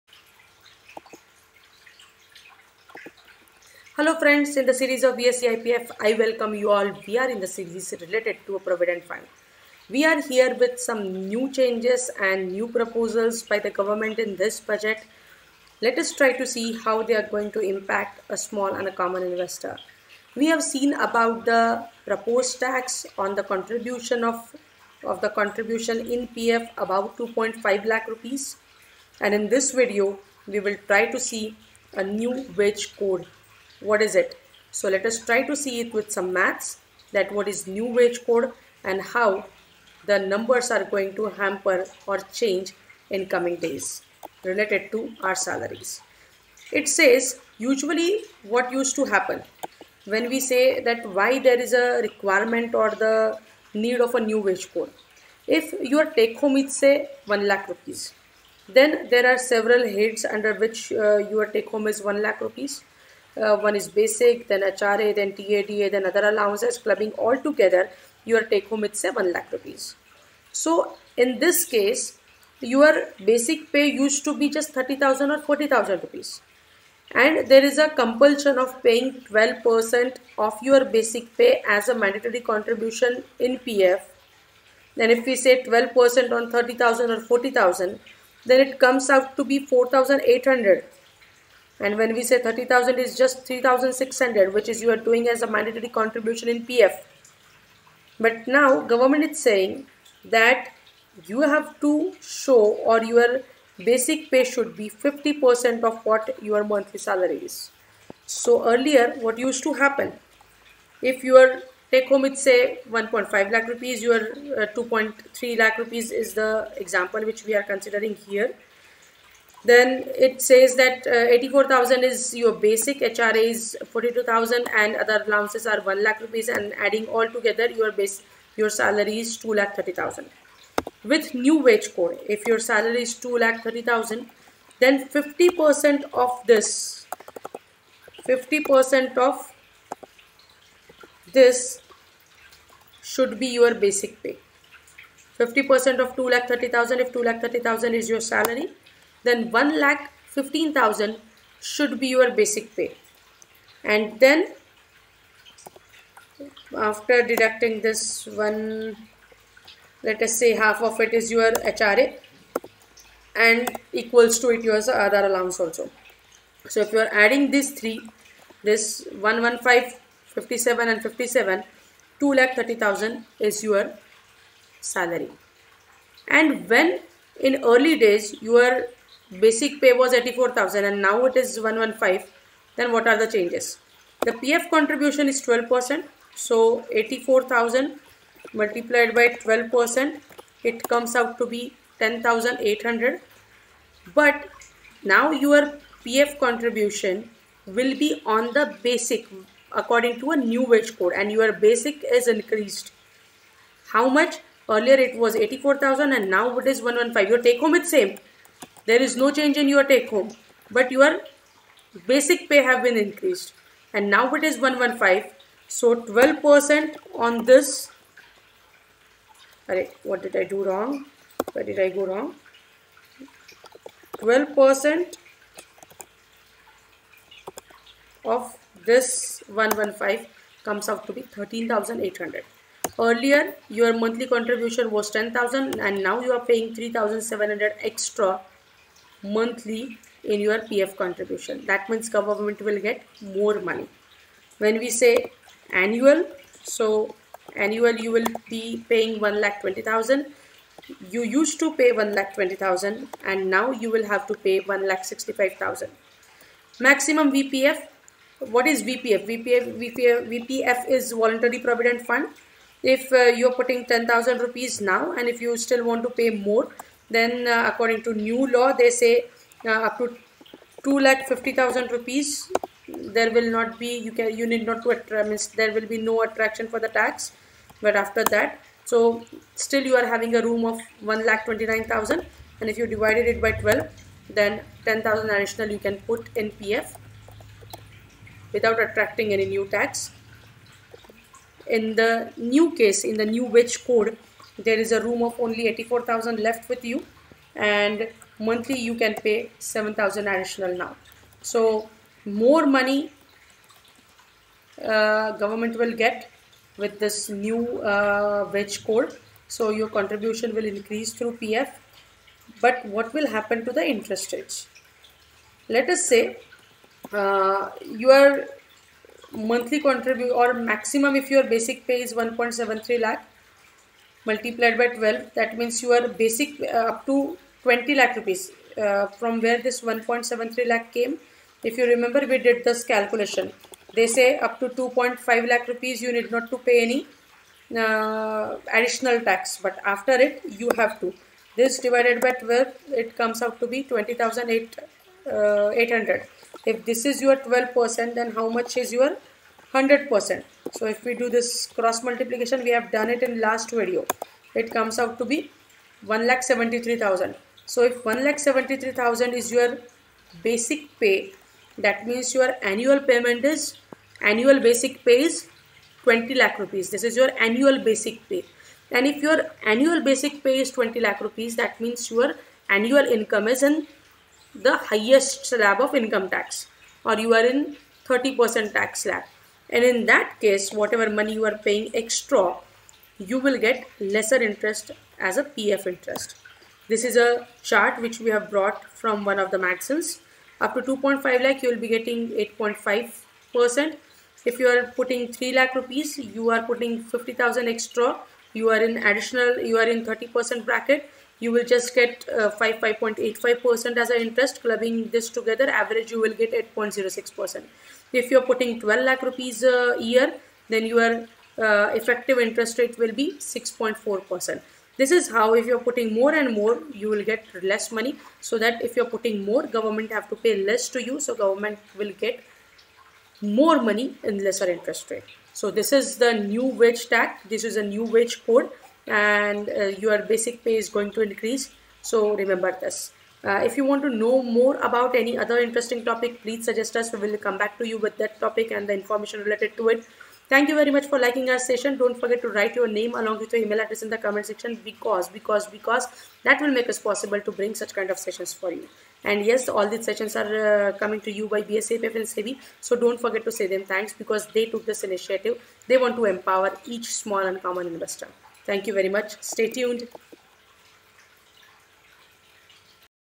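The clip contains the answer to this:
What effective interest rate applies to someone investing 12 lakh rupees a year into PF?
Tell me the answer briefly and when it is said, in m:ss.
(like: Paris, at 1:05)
6.4%, at 6:53.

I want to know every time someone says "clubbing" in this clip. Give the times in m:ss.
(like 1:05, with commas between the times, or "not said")
1:06, 6:44.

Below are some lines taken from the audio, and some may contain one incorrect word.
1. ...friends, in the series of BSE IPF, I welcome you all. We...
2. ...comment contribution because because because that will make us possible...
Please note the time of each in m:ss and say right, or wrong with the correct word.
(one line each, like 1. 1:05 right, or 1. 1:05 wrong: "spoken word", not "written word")
1. 0:04 right
2. 7:24 wrong: "section", not "contribution".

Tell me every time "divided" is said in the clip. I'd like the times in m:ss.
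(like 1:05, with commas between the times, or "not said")
4:42, 5:41.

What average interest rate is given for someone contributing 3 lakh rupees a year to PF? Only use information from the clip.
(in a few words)
8.06%.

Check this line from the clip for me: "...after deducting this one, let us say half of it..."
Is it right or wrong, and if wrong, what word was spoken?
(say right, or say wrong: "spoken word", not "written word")
right.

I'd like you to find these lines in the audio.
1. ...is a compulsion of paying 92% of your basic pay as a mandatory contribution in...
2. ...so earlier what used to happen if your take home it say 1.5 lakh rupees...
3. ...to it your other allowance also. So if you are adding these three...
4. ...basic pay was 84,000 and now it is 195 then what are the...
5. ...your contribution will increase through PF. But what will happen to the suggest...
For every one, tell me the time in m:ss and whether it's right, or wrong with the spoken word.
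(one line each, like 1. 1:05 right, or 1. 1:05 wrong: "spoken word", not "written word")
1. 1:17 wrong: "12", not "92"
2. 1:48 right
3. 2:44 right
4. 2:59 wrong: "115", not "195"
5. 5:09 wrong: "interest", not "suggest".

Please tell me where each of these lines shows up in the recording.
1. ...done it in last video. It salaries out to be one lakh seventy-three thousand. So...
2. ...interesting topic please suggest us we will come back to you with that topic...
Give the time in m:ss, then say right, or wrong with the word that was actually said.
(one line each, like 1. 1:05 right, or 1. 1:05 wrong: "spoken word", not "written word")
1. 5:52 wrong: "comes", not "salaries"
2. 7:15 right.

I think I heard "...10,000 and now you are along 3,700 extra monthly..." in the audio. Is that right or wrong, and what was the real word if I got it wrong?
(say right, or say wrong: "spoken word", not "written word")
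wrong: "paying", not "along".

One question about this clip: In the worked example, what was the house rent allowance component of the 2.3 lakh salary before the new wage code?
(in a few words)
42,000.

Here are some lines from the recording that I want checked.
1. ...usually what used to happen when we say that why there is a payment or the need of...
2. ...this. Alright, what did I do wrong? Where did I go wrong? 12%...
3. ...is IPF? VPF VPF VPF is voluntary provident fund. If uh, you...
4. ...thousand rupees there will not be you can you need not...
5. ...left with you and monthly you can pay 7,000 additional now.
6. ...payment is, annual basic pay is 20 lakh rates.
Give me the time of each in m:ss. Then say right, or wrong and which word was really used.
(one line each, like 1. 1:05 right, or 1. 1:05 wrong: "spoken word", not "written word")
1. 0:47 wrong: "requirement", not "payment"
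2. 3:37 right
3. 4:18 wrong: "VPF", not "IPF"
4. 4:31 right
5. 4:56 right
6. 6:02 wrong: "rupees", not "rates".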